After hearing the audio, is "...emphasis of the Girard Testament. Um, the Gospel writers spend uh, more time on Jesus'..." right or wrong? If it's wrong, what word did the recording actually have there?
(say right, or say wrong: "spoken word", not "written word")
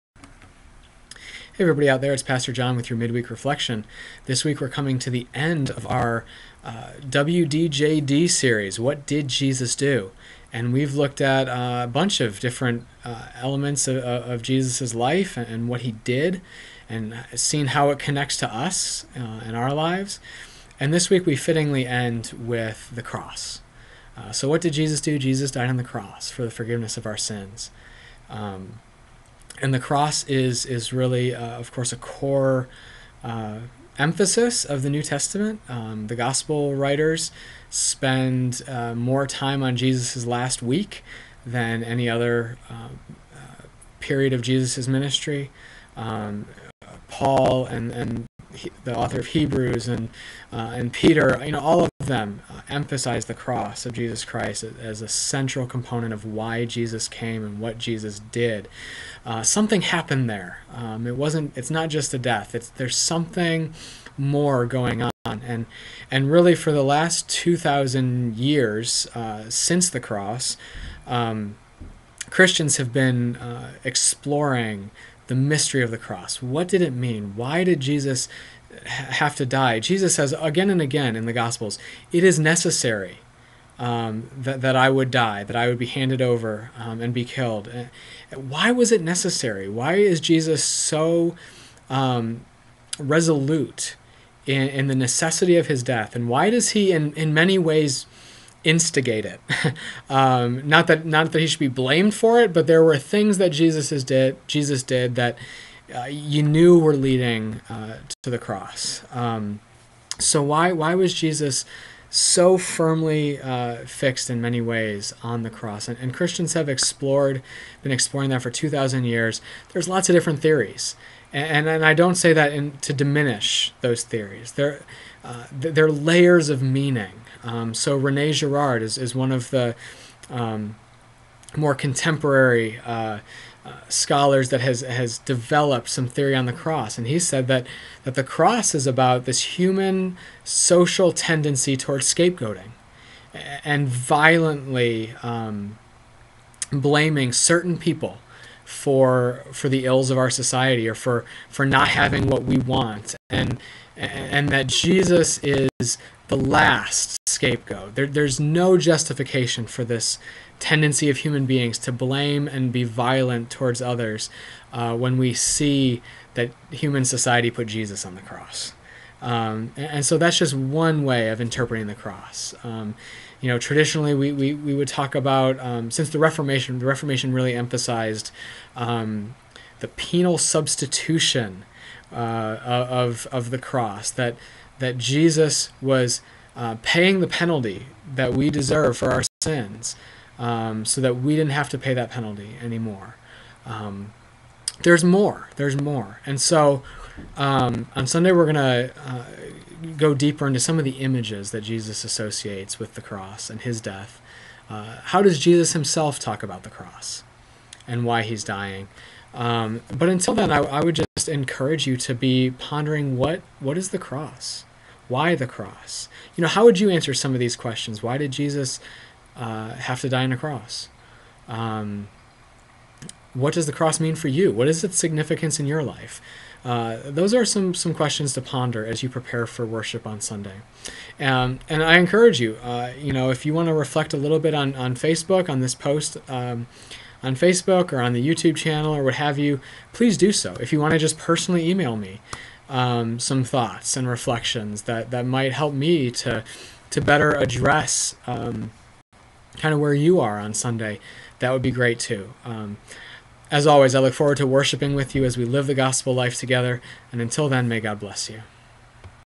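wrong: "New", not "Girard".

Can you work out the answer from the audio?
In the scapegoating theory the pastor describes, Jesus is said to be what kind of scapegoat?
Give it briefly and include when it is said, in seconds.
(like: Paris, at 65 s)
The last scapegoat, at 156 s.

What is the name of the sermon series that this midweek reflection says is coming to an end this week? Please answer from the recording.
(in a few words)
WDJD.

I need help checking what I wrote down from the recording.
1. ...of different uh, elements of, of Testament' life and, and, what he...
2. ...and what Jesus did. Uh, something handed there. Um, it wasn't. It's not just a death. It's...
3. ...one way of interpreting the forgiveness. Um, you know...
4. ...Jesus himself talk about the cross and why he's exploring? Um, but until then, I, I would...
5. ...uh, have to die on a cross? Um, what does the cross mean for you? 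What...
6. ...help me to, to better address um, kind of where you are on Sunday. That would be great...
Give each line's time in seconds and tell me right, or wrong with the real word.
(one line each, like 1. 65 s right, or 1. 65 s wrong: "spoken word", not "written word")
1. 12 s wrong: "Jesus", not "Testament"
2. 57 s wrong: "happened", not "handed"
3. 170 s wrong: "cross", not "forgiveness"
4. 205 s wrong: "dying", not "exploring"
5. 219 s right
6. 245 s right.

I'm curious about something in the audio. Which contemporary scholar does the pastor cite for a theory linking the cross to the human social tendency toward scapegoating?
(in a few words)
Rene Girard.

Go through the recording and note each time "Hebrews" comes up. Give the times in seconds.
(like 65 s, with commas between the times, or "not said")
49 s.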